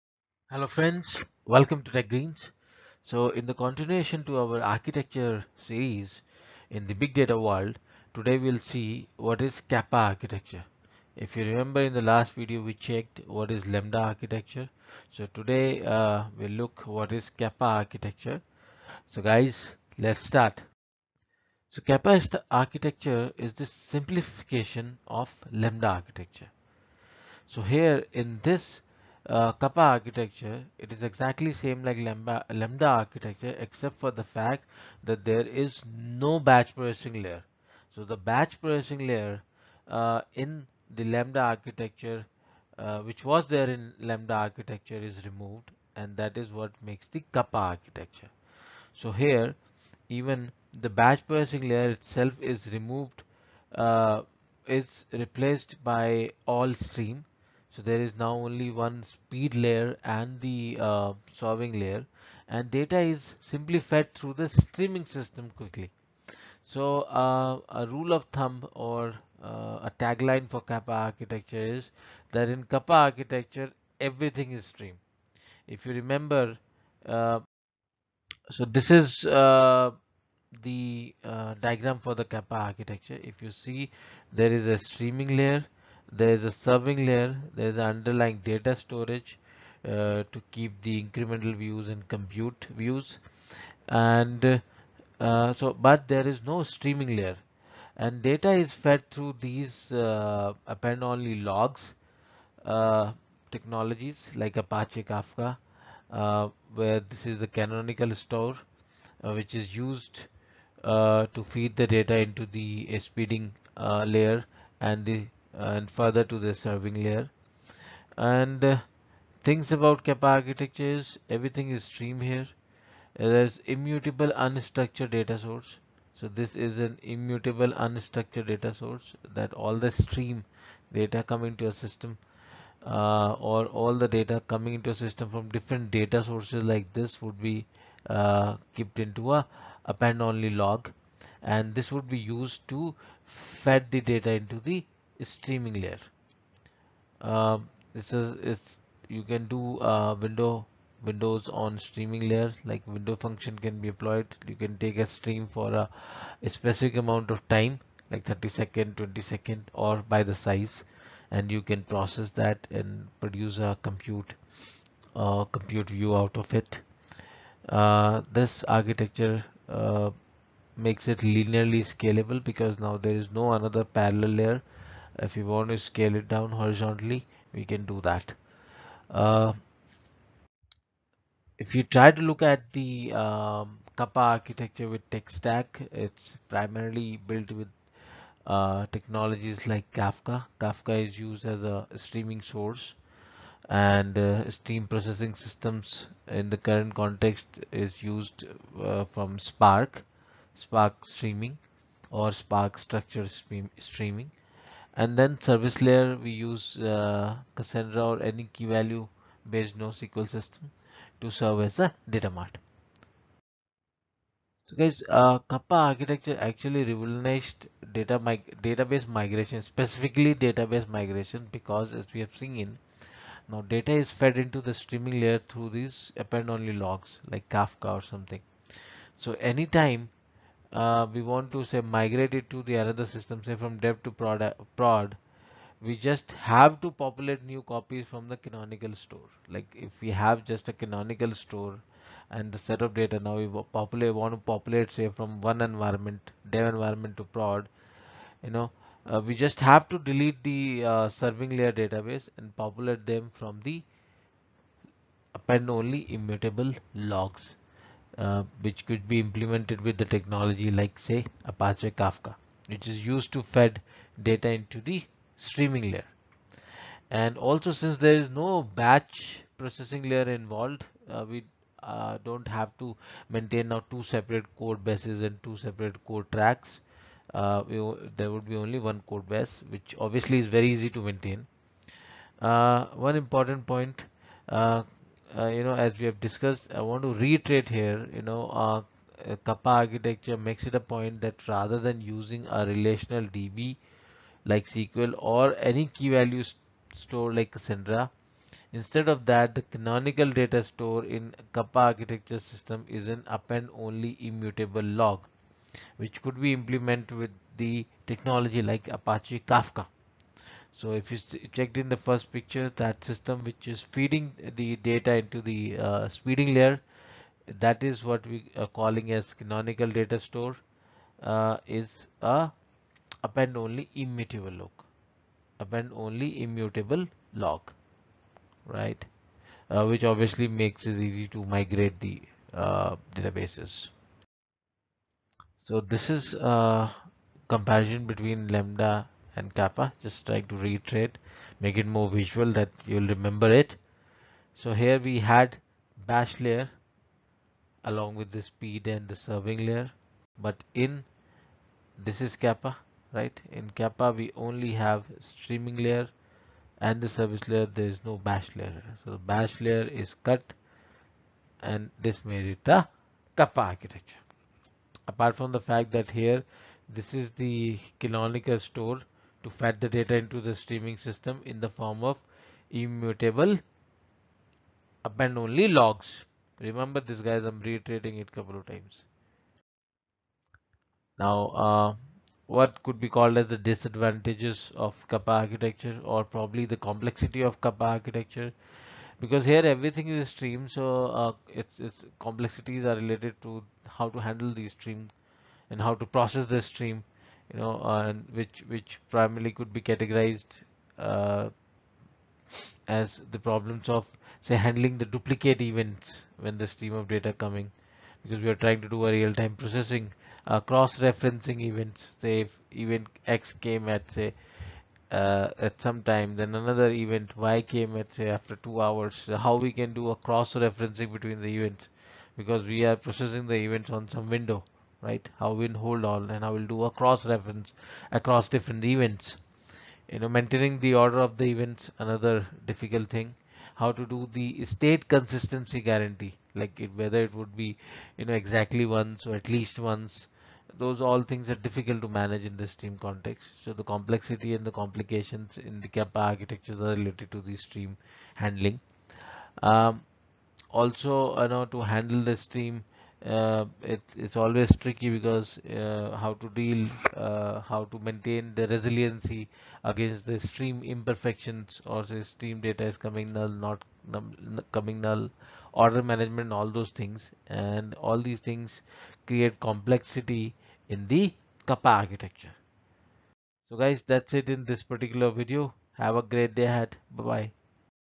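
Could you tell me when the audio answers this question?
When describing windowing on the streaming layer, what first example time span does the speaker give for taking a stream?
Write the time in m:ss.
2:38.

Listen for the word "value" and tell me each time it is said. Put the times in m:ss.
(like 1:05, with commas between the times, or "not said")
3:28, 4:56.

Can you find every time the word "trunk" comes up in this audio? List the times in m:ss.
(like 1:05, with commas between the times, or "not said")
not said.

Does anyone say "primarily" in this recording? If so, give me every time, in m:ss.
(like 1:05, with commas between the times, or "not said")
3:06, 6:39.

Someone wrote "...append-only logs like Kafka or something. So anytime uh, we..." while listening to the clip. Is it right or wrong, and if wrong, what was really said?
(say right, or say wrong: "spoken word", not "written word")
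right.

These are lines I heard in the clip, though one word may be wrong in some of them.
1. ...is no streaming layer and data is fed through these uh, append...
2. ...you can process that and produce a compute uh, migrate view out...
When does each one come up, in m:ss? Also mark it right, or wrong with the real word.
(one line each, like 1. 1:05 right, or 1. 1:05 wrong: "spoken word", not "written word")
1. 1:36 right
2. 2:41 wrong: "compute", not "migrate".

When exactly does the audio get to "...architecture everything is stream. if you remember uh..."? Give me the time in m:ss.
1:12.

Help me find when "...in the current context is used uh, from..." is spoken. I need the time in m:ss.
3:16.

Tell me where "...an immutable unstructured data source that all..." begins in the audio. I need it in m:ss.
2:06.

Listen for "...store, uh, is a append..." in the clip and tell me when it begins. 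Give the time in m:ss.
5:20.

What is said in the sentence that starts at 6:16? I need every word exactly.
Remember this guys, I'm reiterating it couple of times.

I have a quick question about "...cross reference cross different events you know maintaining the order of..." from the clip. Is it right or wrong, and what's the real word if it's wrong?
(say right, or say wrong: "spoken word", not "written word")
wrong: "across", not "cross".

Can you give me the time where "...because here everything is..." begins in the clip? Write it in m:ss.
6:29.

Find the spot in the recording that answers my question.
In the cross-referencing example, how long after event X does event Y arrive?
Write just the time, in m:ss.
6:58.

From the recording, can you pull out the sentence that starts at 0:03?
So in the continuation to our architecture series in the big data world, today we'll see what is Kappa architecture.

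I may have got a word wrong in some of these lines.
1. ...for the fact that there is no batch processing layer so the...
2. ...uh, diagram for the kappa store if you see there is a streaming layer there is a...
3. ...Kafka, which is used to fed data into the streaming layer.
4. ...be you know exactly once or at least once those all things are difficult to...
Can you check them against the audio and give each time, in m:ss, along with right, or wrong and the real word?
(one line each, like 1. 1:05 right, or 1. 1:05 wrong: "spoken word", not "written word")
1. 0:33 right
2. 1:21 wrong: "architecture", not "store"
3. 4:21 right
4. 7:17 right.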